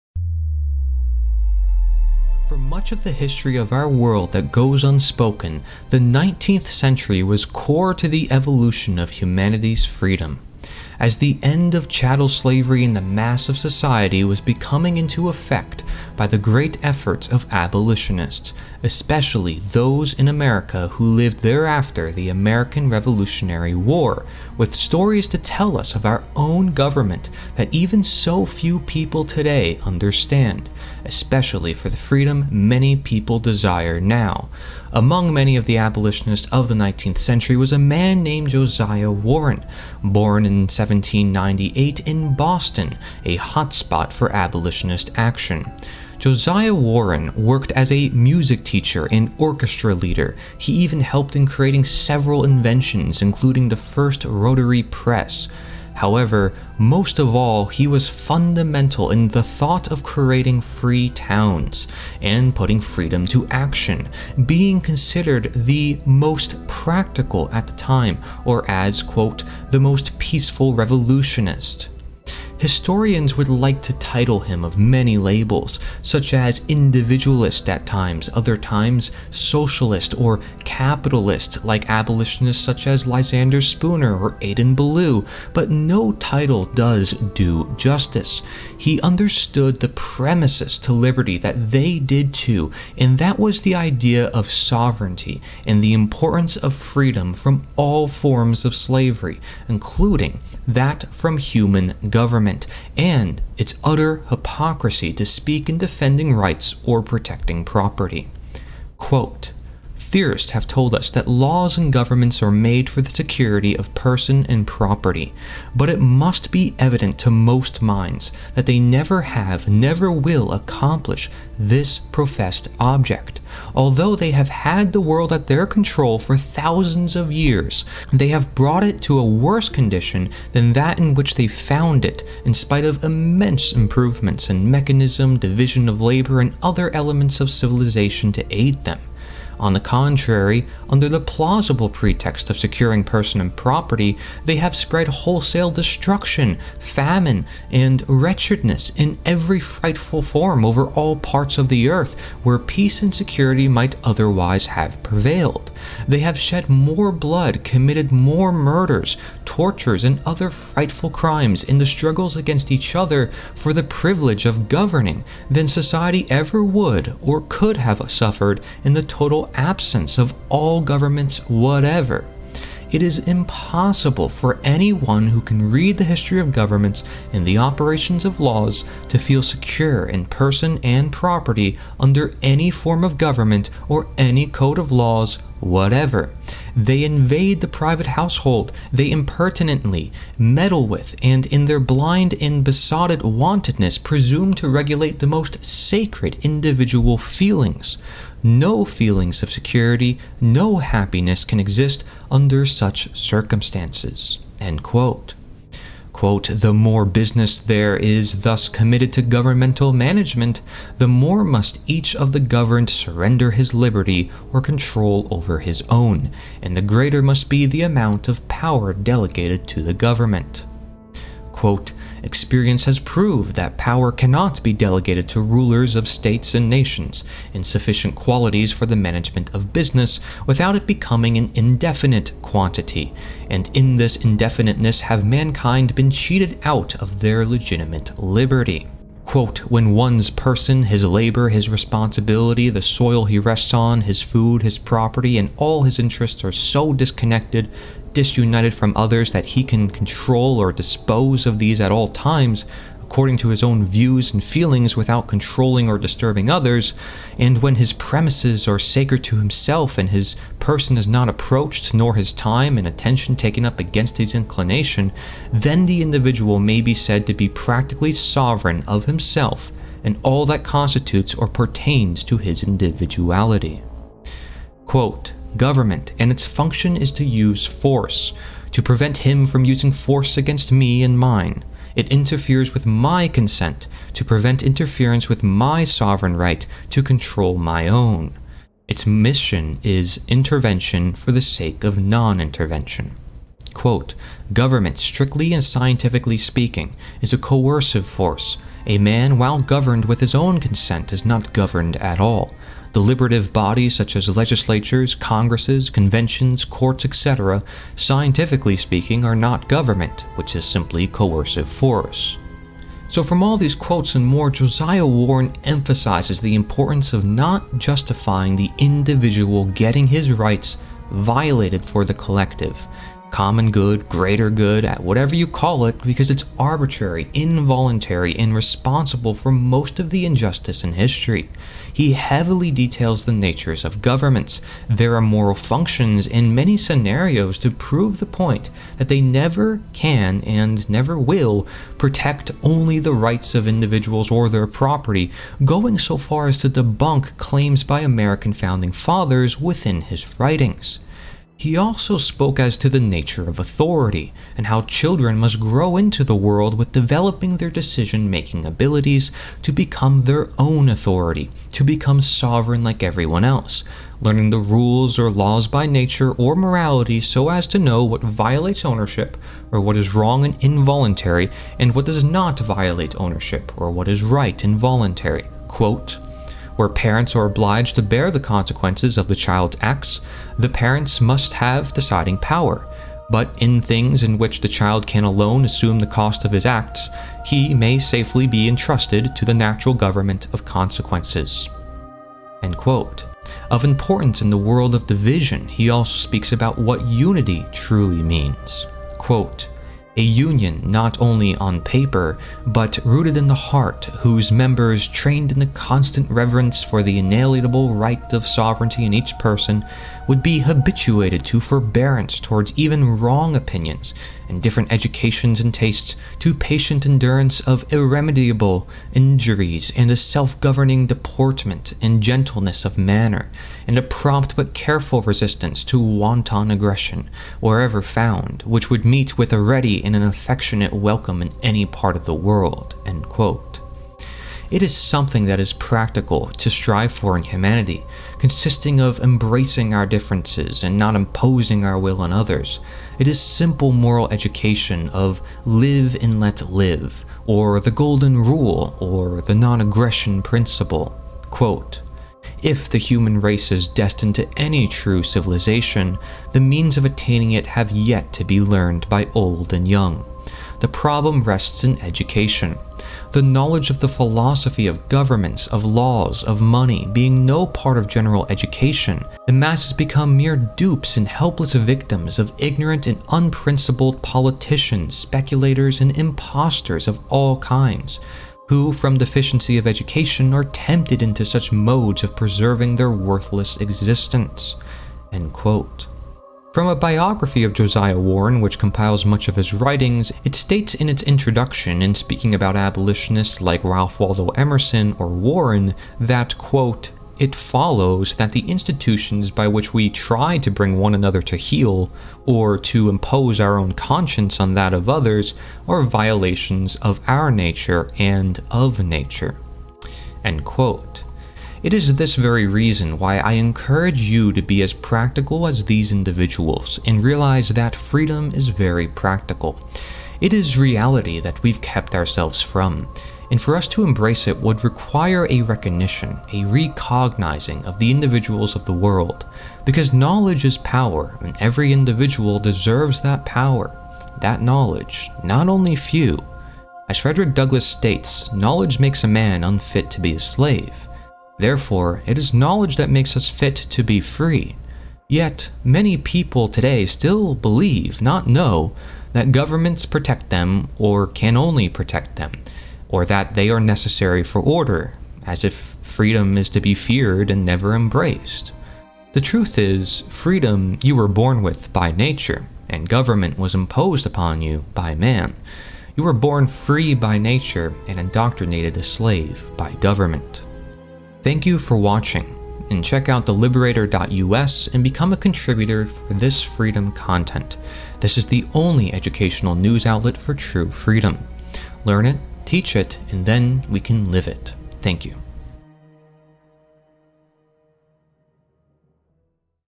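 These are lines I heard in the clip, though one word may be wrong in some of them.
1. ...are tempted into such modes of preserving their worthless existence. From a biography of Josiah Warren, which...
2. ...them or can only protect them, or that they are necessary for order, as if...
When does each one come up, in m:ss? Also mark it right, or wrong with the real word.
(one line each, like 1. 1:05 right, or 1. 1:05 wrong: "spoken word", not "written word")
1. 8:00 right
2. 9:10 right.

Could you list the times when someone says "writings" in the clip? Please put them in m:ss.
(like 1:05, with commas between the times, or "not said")
5:50, 8:09.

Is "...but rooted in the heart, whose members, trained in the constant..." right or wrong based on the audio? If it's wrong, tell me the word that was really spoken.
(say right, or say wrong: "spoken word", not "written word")
right.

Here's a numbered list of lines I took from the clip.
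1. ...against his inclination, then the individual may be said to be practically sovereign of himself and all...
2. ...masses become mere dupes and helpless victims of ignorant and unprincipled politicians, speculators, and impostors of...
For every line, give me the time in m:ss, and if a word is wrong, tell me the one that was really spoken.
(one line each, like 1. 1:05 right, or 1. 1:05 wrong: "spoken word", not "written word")
1. 4:23 right
2. 7:49 right.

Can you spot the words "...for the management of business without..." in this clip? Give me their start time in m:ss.
3:48.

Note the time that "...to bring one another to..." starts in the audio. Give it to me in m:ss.
8:20.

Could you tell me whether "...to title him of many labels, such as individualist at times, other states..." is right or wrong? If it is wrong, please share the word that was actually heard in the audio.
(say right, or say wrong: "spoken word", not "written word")
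wrong: "times", not "states".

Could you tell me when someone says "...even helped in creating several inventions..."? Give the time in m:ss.
0:50.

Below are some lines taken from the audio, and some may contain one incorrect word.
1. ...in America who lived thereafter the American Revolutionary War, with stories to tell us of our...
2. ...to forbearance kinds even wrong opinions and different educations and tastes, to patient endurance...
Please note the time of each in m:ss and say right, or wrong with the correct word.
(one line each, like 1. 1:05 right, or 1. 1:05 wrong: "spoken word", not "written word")
1. 0:20 right
2. 6:51 wrong: "towards", not "kinds".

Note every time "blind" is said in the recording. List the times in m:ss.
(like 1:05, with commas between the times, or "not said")
3:11.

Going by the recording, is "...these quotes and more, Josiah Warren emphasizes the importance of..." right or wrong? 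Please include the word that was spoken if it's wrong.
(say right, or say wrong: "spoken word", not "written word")
right.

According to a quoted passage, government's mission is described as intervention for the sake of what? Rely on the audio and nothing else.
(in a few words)
Non intervention.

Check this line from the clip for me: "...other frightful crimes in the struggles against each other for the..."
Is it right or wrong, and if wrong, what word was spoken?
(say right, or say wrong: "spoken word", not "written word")
right.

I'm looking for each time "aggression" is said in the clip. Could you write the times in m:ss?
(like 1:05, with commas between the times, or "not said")
7:06, 7:29.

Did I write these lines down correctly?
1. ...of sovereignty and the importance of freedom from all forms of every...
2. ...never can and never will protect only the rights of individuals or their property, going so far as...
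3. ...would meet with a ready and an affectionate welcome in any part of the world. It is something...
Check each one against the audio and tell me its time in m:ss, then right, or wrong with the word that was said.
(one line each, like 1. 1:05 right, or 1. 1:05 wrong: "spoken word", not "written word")
1. 1:34 wrong: "slavery", not "every"
2. 5:39 right
3. 7:08 right.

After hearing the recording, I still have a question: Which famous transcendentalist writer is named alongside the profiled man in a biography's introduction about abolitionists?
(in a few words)
Ralph Waldo Emerson.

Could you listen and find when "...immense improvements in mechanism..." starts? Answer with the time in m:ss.
2:13.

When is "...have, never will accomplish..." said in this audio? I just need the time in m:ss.
1:59.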